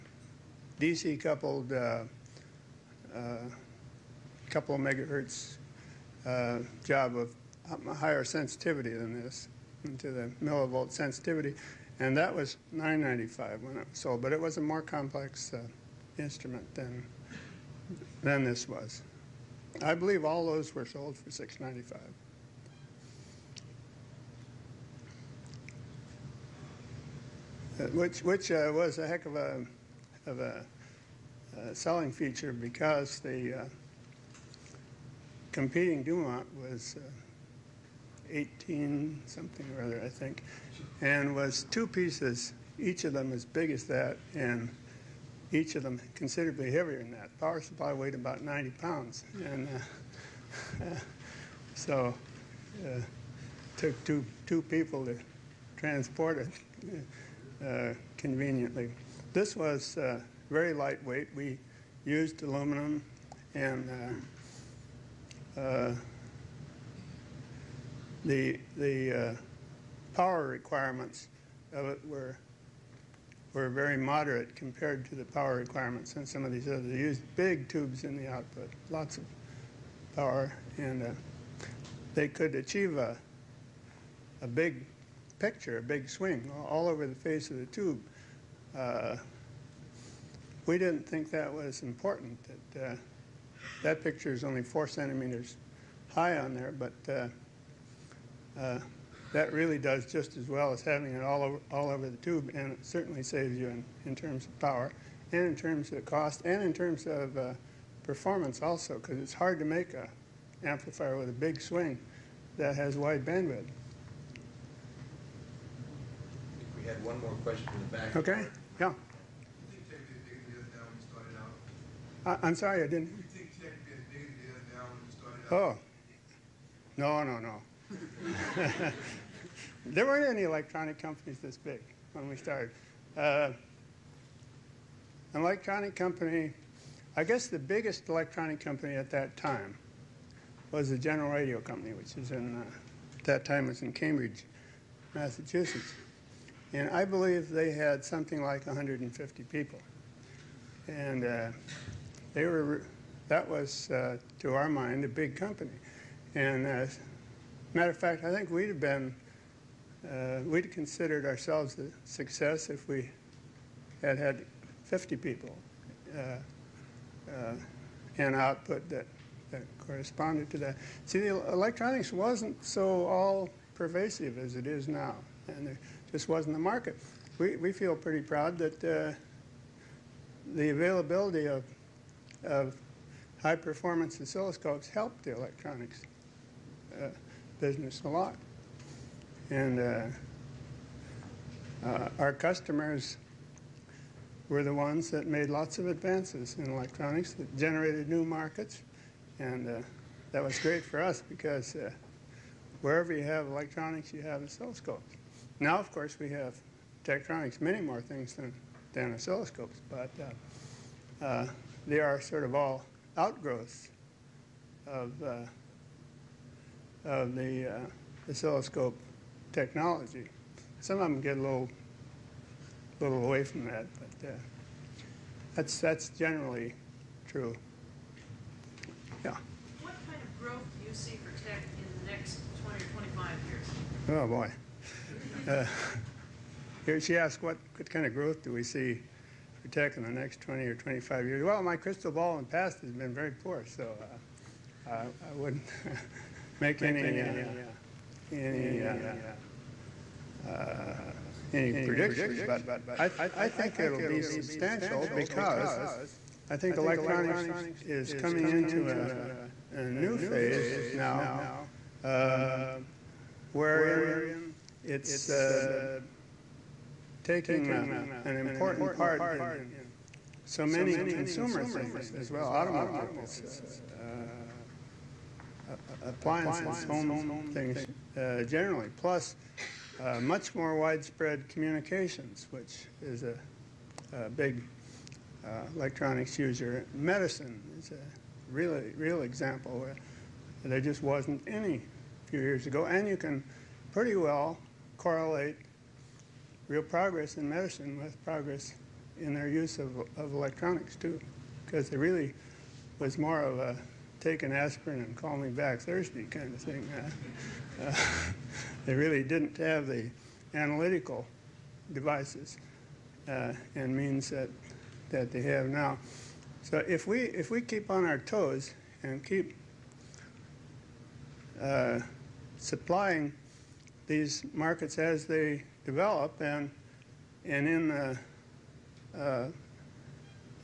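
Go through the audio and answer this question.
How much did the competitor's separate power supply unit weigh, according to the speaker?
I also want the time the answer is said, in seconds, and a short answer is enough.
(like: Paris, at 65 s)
90 pounds, at 48 s.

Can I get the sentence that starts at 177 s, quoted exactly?
We, we feel pretty proud that uh, the availability of, of high performance oscilloscopes helped the electronics uh, business a lot.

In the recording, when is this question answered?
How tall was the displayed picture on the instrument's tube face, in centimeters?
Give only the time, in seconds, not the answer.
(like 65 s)
94 s.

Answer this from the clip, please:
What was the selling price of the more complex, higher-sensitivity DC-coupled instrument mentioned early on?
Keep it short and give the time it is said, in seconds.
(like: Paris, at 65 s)
995, at 12 s.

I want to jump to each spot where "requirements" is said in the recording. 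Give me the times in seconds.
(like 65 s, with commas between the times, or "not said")
70 s, 75 s.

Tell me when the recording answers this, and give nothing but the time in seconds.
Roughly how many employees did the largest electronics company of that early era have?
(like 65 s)
148 s.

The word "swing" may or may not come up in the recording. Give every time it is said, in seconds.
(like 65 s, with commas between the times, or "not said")
86 s, 111 s.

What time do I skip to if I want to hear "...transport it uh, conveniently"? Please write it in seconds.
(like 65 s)
55 s.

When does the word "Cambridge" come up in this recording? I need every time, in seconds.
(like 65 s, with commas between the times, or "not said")
143 s.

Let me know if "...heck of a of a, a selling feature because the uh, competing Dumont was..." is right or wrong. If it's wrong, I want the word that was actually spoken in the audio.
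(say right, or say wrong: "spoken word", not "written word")
right.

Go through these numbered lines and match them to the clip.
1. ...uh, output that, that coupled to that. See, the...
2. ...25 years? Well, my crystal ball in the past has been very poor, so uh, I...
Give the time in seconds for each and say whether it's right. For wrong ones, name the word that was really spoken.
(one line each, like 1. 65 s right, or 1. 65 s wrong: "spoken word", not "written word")
1. 168 s wrong: "corresponded", not "coupled"
2. 240 s right.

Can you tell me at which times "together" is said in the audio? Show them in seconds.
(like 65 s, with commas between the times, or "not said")
not said.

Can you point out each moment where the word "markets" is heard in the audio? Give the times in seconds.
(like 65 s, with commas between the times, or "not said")
176 s, 198 s, 324 s.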